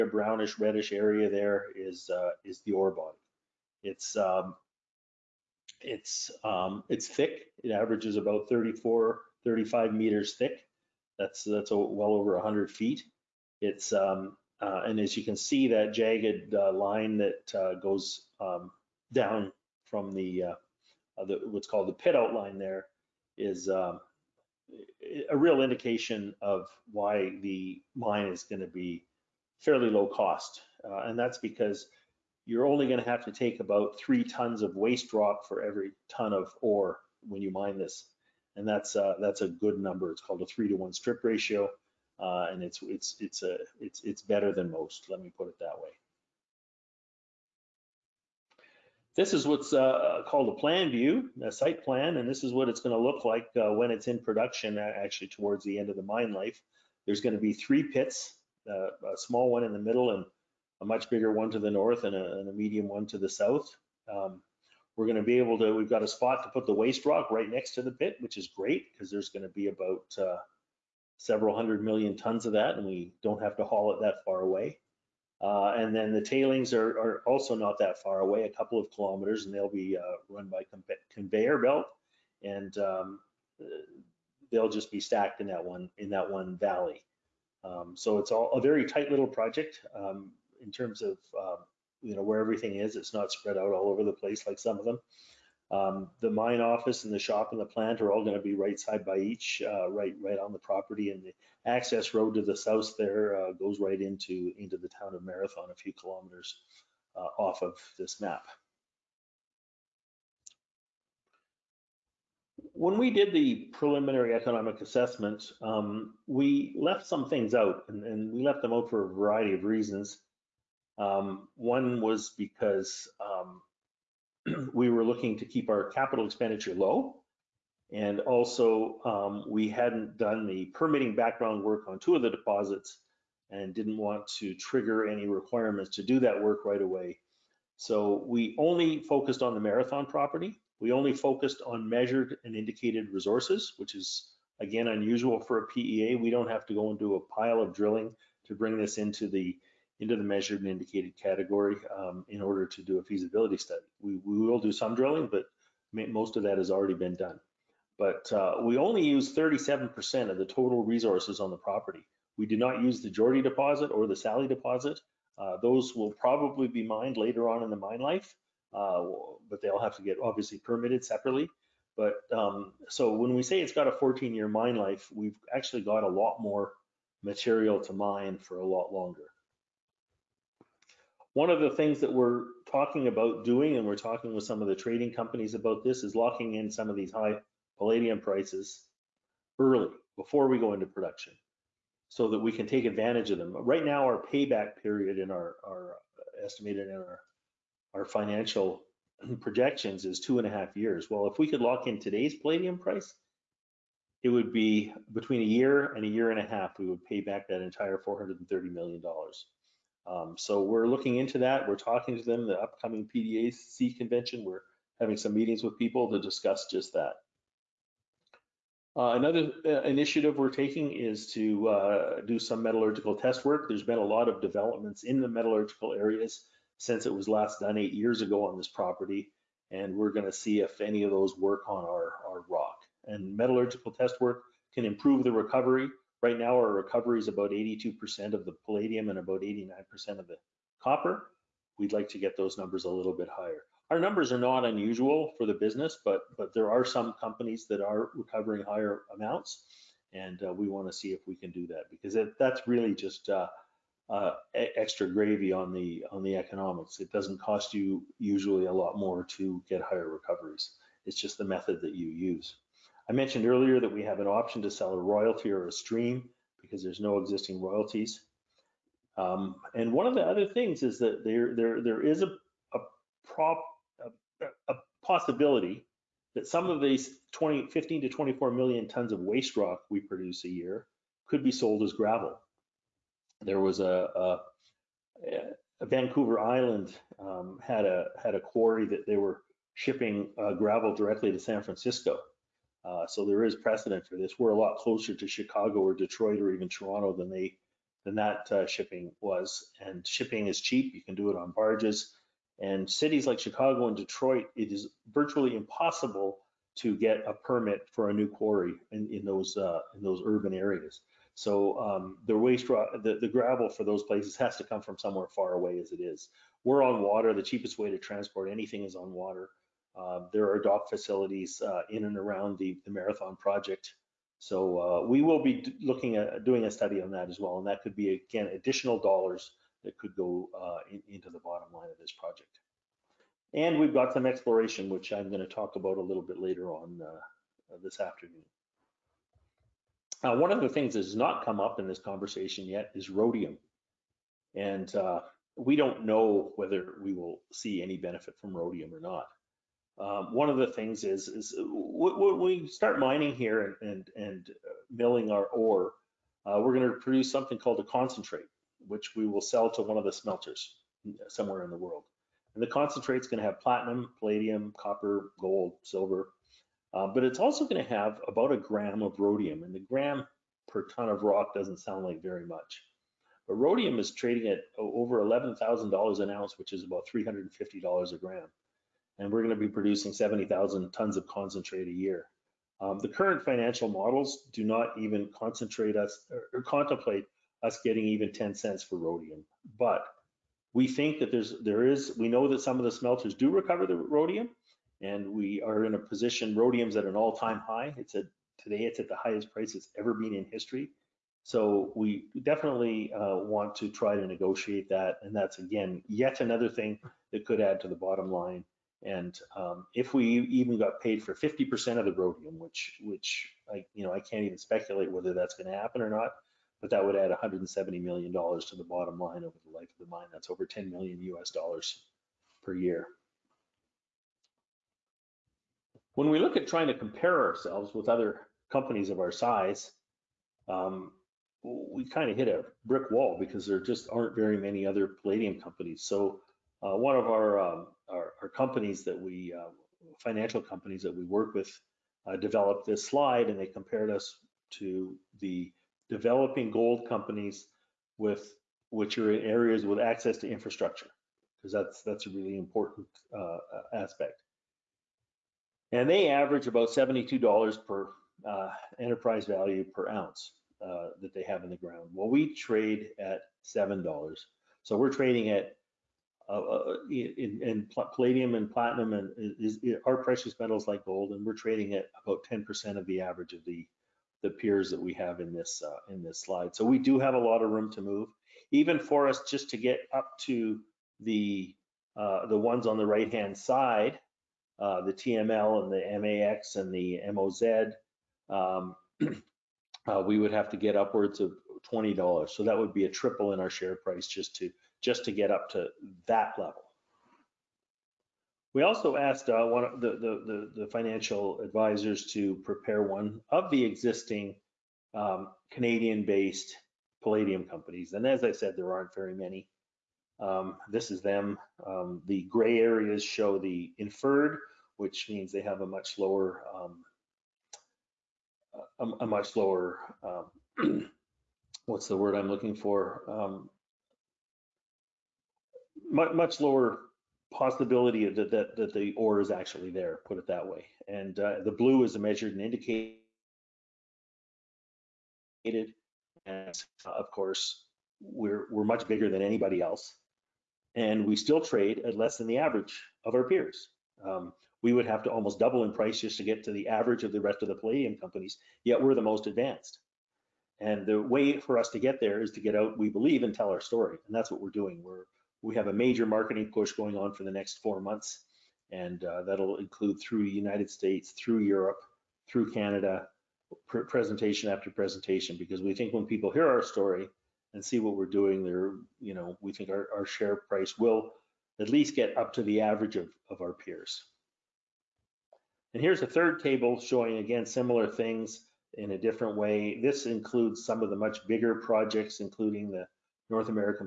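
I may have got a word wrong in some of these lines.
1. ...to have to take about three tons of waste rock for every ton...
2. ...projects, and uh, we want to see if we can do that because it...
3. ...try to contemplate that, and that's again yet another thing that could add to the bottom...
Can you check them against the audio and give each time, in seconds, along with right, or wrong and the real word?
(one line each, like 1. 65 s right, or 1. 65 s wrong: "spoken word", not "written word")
1. 33 s right
2. 249 s wrong: "amounts", not "projects"
3. 403 s wrong: "negotiate", not "contemplate".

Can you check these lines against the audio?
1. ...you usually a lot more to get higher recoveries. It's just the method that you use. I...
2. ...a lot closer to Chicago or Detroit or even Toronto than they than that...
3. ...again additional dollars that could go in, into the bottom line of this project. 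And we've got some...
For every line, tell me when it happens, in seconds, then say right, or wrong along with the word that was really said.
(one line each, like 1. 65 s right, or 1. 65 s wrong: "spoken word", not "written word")
1. 257 s right
2. 294 s right
3. 328 s right.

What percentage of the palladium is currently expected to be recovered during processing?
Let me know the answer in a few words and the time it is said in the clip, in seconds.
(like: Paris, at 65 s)
82%, at 237 s.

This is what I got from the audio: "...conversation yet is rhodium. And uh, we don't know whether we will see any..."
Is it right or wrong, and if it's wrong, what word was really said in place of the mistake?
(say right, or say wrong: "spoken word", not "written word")
right.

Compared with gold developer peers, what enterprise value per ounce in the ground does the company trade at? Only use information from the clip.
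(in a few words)
$7.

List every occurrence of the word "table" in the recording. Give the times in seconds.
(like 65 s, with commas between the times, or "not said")
576 s.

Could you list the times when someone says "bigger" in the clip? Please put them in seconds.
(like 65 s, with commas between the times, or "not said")
61 s, 539 s, 581 s.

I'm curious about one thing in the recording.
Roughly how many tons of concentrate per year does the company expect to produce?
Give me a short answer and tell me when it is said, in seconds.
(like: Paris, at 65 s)
70,000, at 380 s.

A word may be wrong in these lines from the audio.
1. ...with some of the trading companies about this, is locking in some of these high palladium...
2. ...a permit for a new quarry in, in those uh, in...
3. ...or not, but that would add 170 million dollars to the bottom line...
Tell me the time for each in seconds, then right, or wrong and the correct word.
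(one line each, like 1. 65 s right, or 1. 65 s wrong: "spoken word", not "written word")
1. 184 s right
2. 307 s right
3. 415 s right.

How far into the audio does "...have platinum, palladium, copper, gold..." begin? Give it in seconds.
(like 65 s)
363 s.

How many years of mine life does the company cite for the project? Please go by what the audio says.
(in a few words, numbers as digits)
14.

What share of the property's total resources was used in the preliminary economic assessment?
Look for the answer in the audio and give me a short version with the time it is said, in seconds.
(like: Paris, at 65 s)
37%, at 159 s.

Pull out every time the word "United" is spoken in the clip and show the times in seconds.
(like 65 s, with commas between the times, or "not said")
560 s.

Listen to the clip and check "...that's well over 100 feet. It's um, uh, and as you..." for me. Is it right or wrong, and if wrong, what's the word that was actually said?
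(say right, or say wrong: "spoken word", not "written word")
right.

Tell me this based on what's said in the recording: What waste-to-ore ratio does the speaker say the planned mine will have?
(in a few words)
3 to 1.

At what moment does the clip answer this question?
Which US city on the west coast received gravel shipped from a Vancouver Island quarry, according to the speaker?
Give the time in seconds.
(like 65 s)
291 s.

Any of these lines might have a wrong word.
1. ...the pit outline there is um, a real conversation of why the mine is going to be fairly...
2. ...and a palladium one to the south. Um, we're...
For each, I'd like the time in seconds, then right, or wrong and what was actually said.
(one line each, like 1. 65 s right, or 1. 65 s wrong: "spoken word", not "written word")
1. 21 s wrong: "indication", not "conversation"
2. 62 s wrong: "medium", not "palladium".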